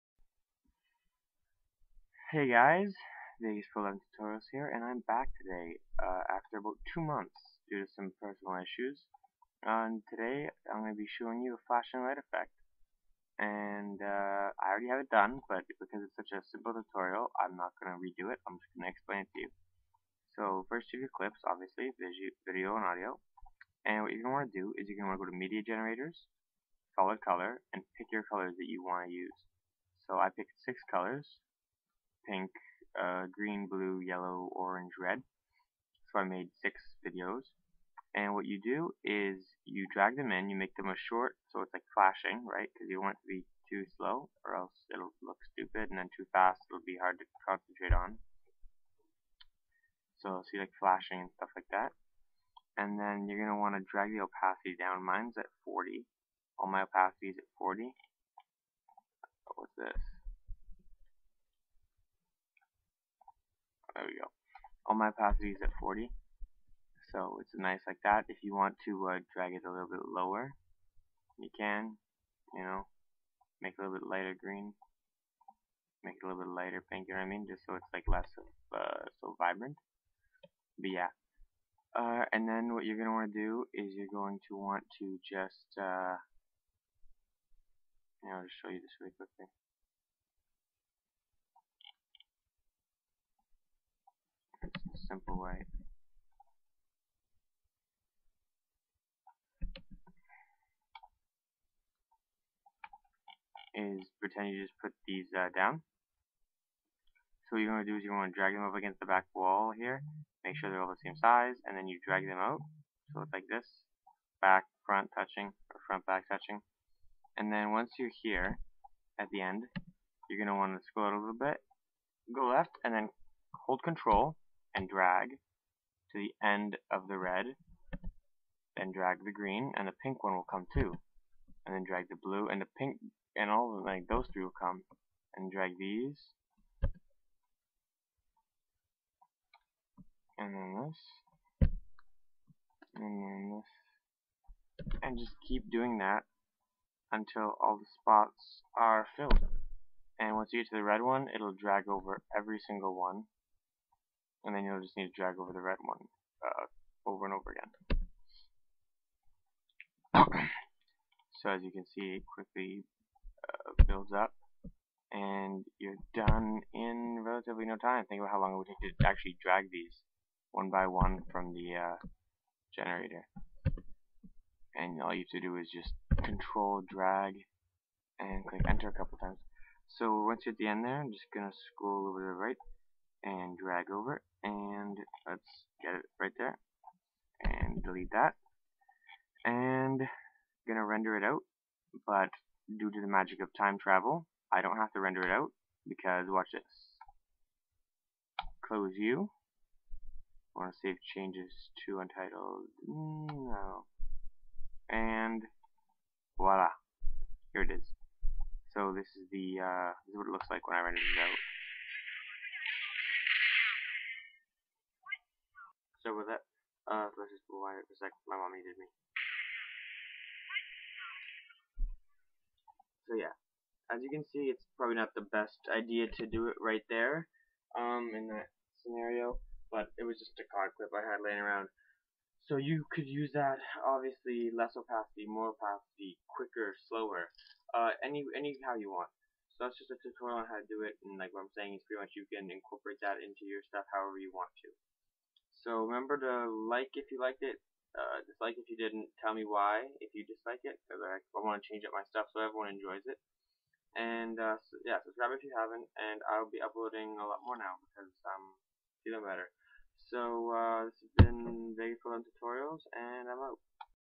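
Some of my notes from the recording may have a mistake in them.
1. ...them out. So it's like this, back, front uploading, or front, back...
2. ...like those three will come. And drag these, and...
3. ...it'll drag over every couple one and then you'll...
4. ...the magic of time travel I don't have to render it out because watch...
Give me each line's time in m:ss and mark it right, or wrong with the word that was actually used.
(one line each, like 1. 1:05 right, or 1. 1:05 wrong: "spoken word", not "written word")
1. 1:52 wrong: "touching", not "uploading"
2. 2:13 right
3. 2:31 wrong: "single", not "couple"
4. 3:13 right.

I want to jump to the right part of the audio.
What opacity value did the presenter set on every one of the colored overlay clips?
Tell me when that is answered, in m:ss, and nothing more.
0:55.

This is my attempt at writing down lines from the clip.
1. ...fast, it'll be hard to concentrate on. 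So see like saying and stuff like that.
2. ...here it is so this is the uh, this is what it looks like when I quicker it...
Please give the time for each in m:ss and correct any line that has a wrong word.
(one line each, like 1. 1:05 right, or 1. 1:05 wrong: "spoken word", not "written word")
1. 0:46 wrong: "flashing", not "saying"
2. 3:27 wrong: "render", not "quicker".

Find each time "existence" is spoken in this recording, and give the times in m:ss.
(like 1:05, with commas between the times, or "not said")
not said.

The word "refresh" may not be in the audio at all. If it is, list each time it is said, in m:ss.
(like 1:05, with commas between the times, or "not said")
not said.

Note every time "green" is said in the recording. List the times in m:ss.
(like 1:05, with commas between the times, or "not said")
0:33, 1:14, 2:09.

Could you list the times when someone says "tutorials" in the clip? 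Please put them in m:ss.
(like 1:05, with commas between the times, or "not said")
0:04, 0:16, 4:00, 4:22.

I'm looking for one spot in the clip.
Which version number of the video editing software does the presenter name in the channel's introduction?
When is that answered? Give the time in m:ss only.
0:03.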